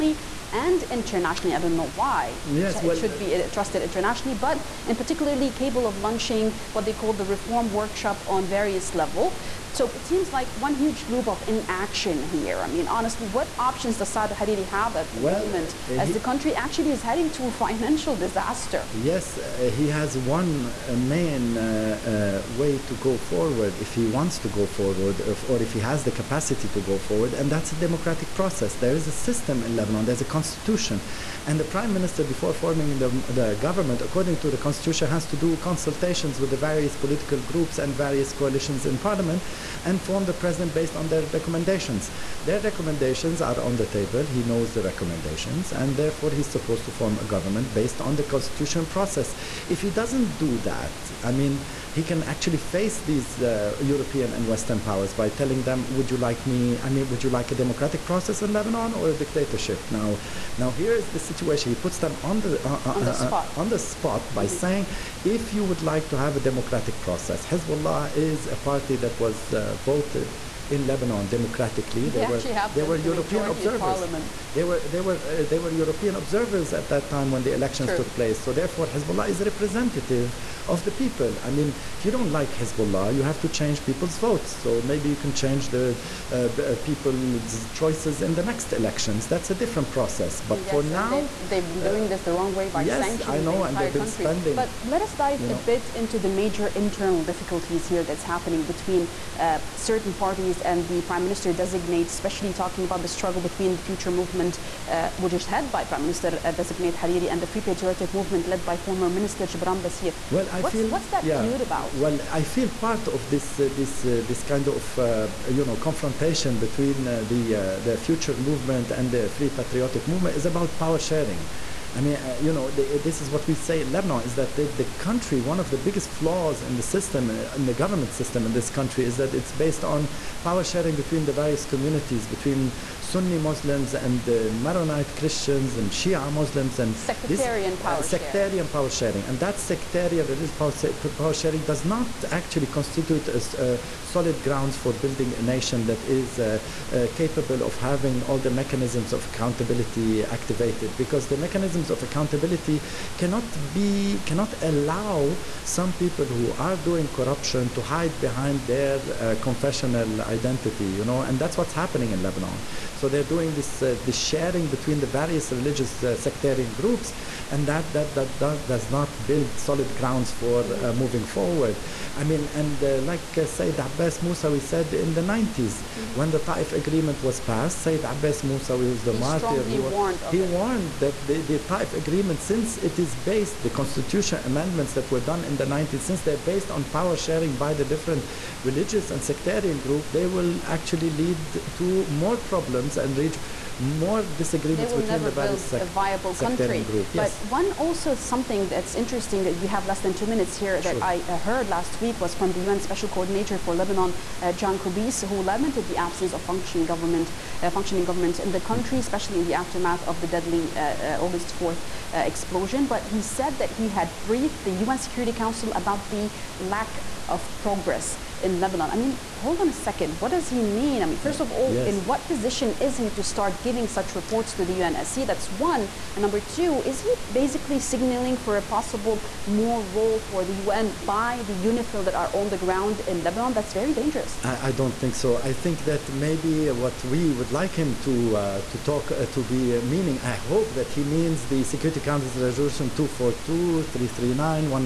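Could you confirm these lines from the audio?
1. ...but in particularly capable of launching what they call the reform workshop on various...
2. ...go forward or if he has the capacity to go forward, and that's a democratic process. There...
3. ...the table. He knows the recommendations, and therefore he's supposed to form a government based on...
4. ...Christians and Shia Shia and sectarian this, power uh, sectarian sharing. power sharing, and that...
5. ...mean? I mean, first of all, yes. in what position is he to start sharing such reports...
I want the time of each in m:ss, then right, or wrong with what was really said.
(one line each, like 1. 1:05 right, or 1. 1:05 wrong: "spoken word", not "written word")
1. 0:04 right
2. 0:24 right
3. 0:43 right
4. 2:15 wrong: "Muslims", not "Shia"
5. 3:40 wrong: "giving", not "sharing".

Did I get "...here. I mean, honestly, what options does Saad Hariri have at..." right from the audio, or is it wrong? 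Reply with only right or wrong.
right.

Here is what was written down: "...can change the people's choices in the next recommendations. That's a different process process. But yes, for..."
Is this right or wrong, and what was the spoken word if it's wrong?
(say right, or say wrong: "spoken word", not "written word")
wrong: "elections", not "recommendations".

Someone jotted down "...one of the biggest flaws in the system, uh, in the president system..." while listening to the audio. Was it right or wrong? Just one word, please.
wrong.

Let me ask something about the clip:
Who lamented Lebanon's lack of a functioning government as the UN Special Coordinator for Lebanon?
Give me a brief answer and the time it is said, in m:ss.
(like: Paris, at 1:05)
John Kubis, at 3:24.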